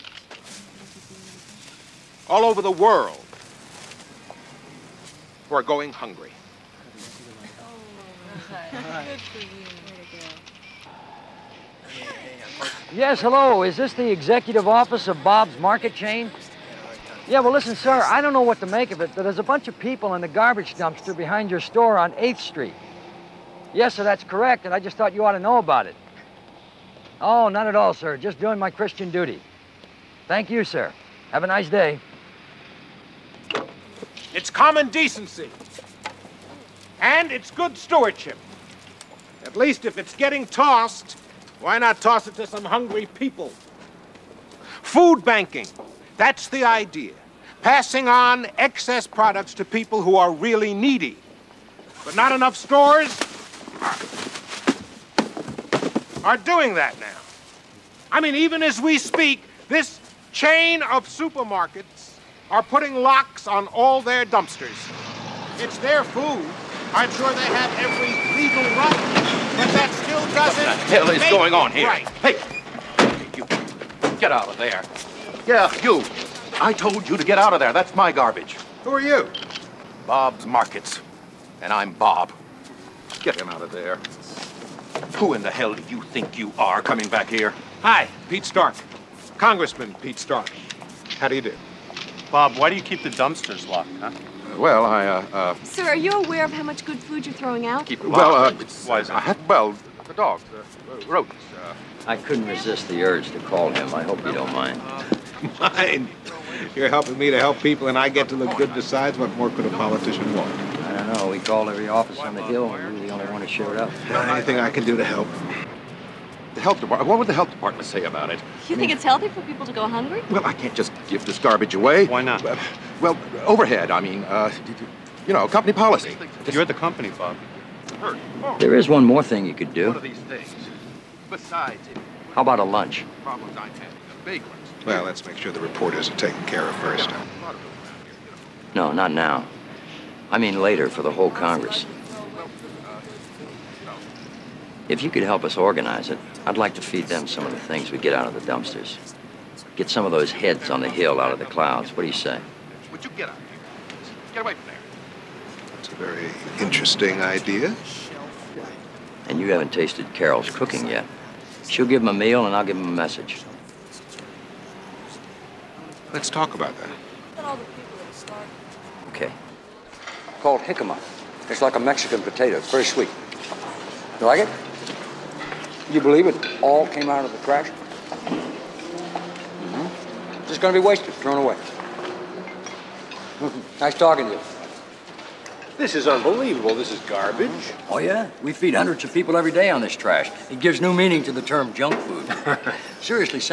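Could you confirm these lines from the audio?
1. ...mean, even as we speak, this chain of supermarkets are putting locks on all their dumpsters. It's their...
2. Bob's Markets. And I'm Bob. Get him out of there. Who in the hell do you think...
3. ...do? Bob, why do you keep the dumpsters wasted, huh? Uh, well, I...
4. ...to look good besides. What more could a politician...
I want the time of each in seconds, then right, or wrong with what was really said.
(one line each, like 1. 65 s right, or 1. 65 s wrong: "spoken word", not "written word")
1. 58 s right
2. 80 s right
3. 91 s wrong: "locked", not "wasted"
4. 108 s right.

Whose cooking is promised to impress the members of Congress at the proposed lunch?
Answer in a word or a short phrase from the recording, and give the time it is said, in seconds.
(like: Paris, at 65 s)
Carol, at 160 s.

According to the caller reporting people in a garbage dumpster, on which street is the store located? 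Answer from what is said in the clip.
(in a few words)
8th Street.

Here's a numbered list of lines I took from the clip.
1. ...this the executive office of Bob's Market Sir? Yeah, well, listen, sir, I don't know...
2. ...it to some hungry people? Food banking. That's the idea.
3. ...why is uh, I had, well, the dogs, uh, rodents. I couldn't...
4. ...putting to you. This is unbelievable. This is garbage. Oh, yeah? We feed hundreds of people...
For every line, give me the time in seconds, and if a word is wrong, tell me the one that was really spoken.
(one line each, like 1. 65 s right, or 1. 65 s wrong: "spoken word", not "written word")
1. 13 s wrong: "Chain", not "Sir"
2. 42 s right
3. 98 s right
4. 183 s wrong: "talking", not "putting".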